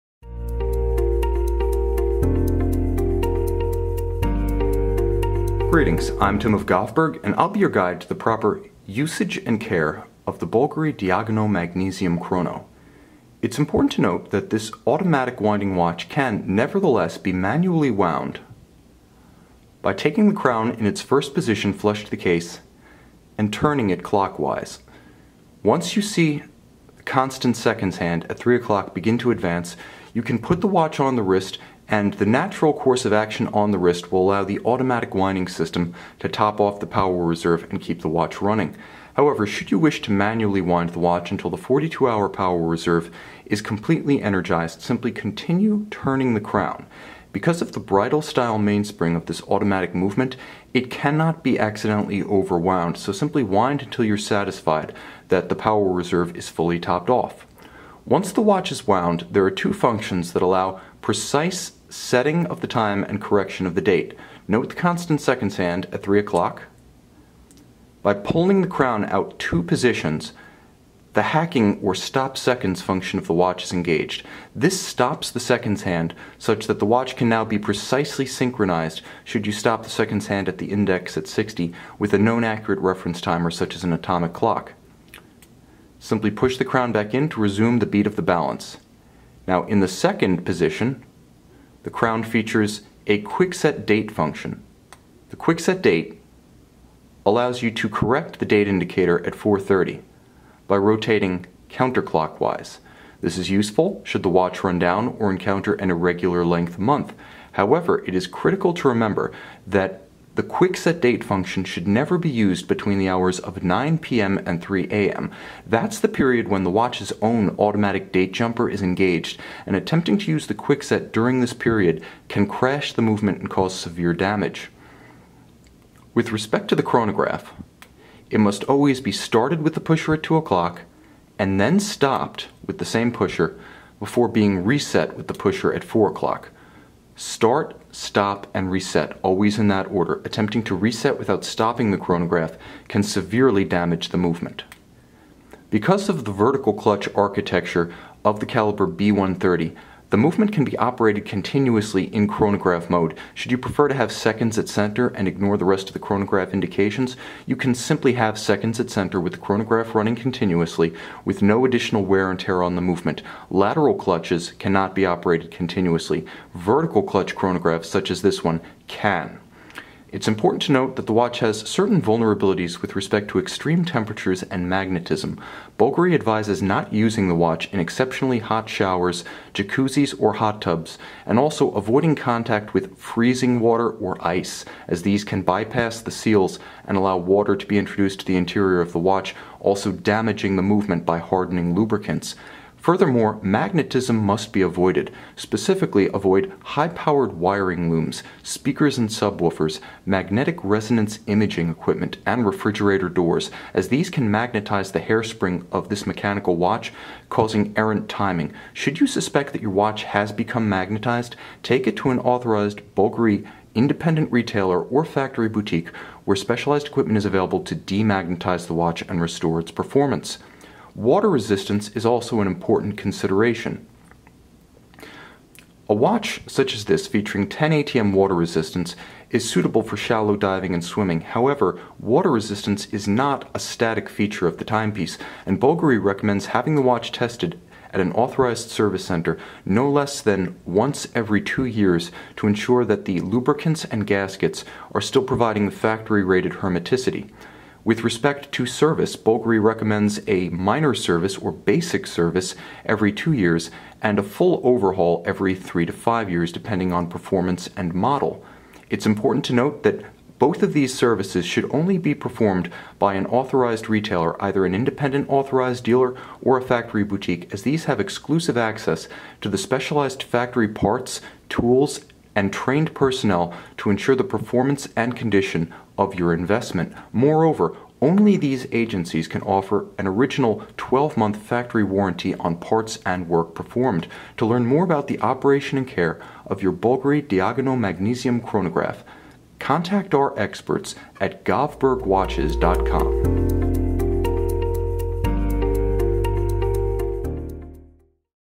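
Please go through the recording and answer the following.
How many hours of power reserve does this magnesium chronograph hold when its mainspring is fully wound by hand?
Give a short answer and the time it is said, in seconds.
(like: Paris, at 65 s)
42, at 41 s.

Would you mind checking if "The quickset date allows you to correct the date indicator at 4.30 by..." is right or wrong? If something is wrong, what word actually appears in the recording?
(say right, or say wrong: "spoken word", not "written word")
right.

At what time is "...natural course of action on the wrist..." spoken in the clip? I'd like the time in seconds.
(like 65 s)
32 s.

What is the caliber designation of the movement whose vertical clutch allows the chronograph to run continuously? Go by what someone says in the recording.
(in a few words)
B130.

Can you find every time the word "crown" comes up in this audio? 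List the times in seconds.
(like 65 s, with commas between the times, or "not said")
20 s, 46 s, 68 s, 86 s, 91 s.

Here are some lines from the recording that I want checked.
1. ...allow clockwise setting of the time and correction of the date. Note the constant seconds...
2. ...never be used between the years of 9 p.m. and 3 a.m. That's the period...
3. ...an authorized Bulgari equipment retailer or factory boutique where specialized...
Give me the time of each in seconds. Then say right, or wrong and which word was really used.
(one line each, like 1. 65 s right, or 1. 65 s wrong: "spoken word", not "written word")
1. 60 s wrong: "precise", not "clockwise"
2. 111 s wrong: "hours", not "years"
3. 212 s wrong: "independent", not "equipment".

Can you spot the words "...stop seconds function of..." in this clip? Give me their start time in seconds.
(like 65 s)
71 s.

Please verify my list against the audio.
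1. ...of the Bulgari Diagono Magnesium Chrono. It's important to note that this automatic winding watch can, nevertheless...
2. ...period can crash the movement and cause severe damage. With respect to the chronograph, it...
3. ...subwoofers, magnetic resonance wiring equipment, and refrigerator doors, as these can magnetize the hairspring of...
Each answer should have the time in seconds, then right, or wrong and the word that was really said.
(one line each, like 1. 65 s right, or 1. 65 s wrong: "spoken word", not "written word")
1. 10 s right
2. 121 s right
3. 199 s wrong: "imaging", not "wiring".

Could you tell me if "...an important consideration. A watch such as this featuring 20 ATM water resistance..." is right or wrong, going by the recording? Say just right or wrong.
wrong.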